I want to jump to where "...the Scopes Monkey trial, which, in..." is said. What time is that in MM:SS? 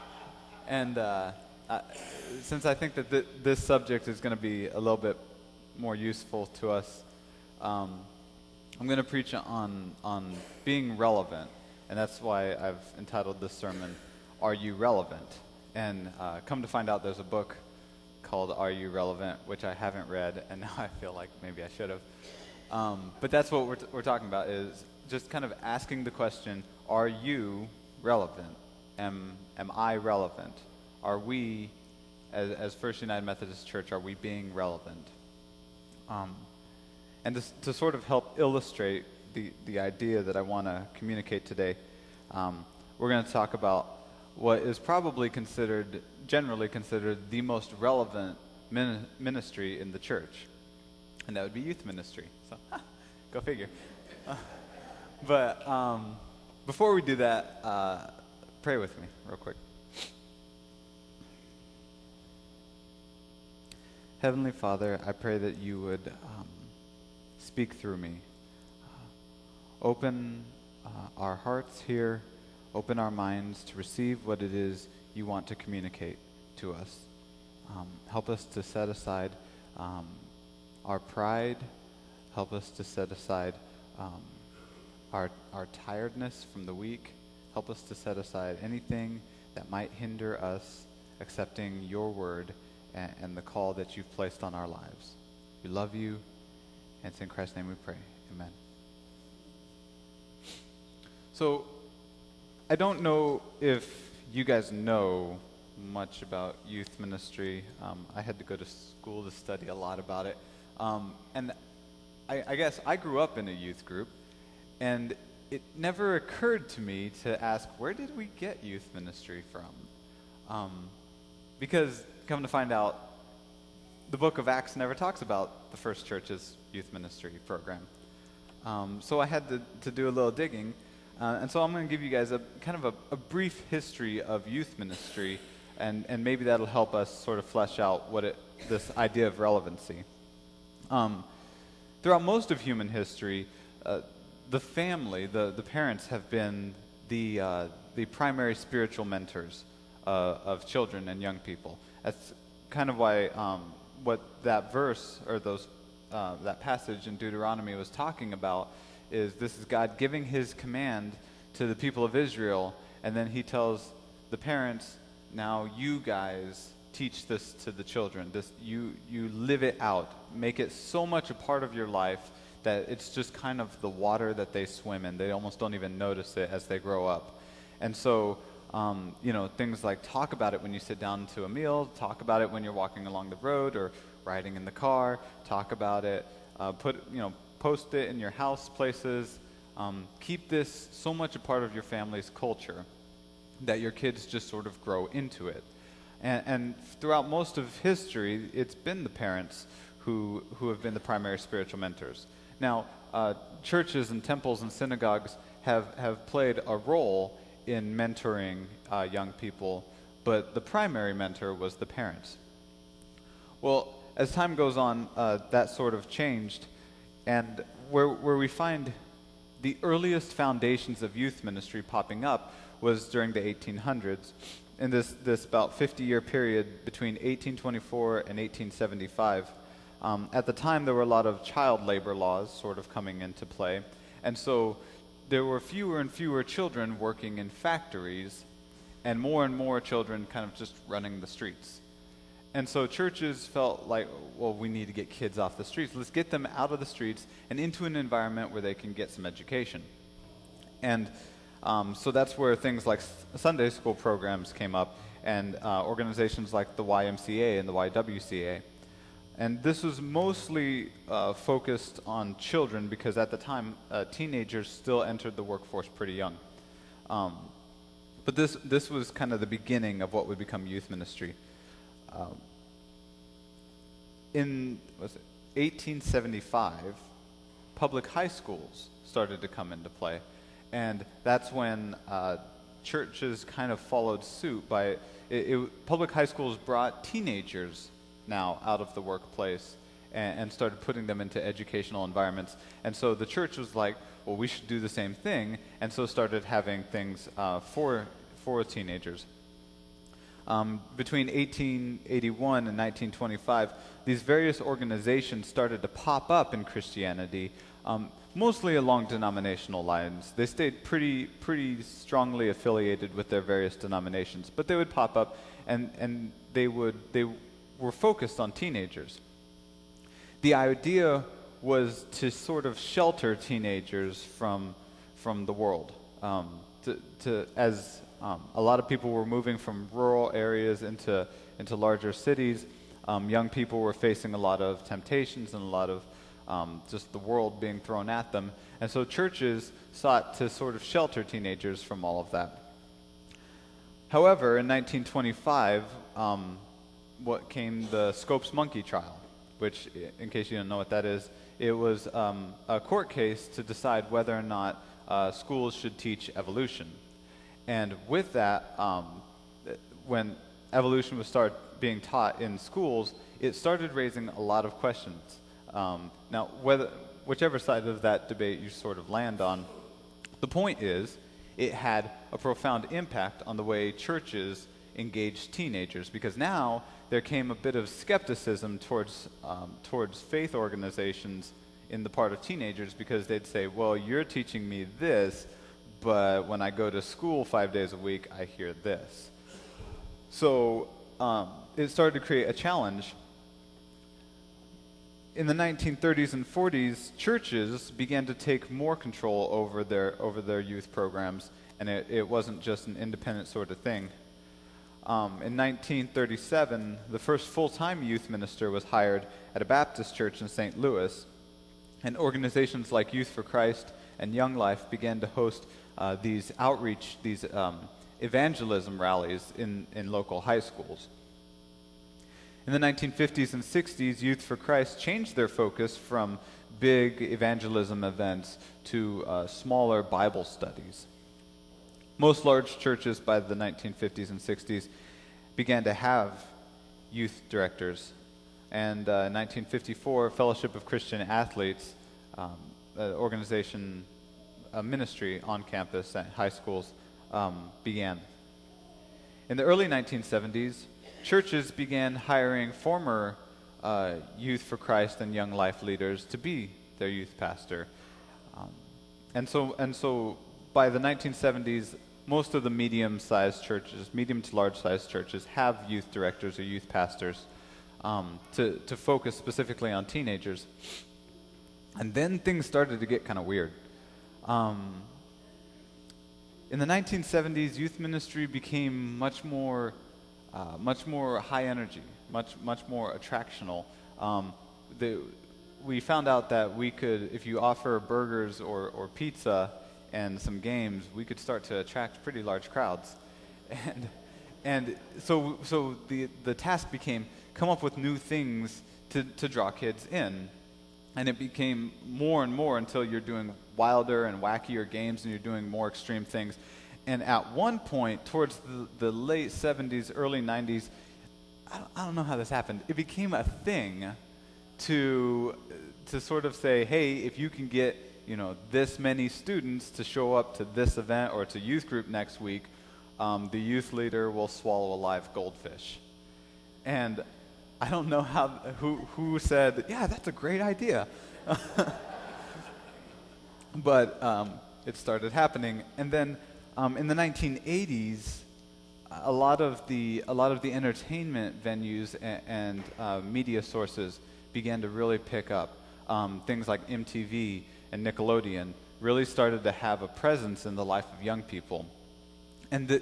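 05:47.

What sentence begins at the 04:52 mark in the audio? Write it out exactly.
And so the church was like, well, we should do the same thing, and so started having things uh, for for teenagers.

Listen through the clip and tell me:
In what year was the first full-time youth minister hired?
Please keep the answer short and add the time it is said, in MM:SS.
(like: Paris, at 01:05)
1937, at 06:45.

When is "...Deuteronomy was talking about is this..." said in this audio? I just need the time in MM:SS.
02:37.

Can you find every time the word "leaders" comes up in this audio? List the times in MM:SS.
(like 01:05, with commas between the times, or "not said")
07:35, 08:43.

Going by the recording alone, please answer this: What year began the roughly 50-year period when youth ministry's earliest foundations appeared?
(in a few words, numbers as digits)
1824.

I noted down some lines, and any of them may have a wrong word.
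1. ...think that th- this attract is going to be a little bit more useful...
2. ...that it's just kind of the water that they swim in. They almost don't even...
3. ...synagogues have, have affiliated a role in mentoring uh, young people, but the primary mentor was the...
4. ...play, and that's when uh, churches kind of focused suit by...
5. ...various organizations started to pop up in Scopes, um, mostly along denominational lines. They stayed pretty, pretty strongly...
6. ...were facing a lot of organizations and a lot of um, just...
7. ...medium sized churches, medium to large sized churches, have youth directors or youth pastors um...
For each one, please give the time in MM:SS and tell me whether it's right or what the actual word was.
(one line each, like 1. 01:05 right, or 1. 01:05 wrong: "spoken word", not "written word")
1. 00:02 wrong: "subject", not "attract"
2. 02:52 right
3. 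03:24 wrong: "played", not "affiliated"
4. 04:39 wrong: "followed", not "focused"
5. 05:04 wrong: "Christianity", not "Scopes"
6. 05:33 wrong: "temptations", not "organizations"
7. 07:42 right.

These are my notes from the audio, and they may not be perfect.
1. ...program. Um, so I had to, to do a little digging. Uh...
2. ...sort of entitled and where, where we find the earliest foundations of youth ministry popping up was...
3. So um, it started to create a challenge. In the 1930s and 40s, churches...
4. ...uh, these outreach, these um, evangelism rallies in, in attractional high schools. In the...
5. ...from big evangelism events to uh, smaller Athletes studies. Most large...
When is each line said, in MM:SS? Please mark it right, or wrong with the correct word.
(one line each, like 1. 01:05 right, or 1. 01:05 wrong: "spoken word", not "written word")
1. 02:07 right
2. 03:35 wrong: "changed", not "entitled"
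3. 06:30 right
4. 06:55 wrong: "local", not "attractional"
5. 07:05 wrong: "Bible", not "Athletes".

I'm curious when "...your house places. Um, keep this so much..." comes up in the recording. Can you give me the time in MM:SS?
03:08.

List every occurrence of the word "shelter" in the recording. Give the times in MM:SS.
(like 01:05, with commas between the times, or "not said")
05:22, 05:40.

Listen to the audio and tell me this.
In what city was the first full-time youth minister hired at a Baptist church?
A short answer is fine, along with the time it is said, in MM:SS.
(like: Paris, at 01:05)
St. Louis, at 06:50.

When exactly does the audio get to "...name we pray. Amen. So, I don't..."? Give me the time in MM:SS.
01:37.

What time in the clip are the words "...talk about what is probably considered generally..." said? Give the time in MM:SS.
00:43.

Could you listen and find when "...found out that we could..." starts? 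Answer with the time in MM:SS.
08:05.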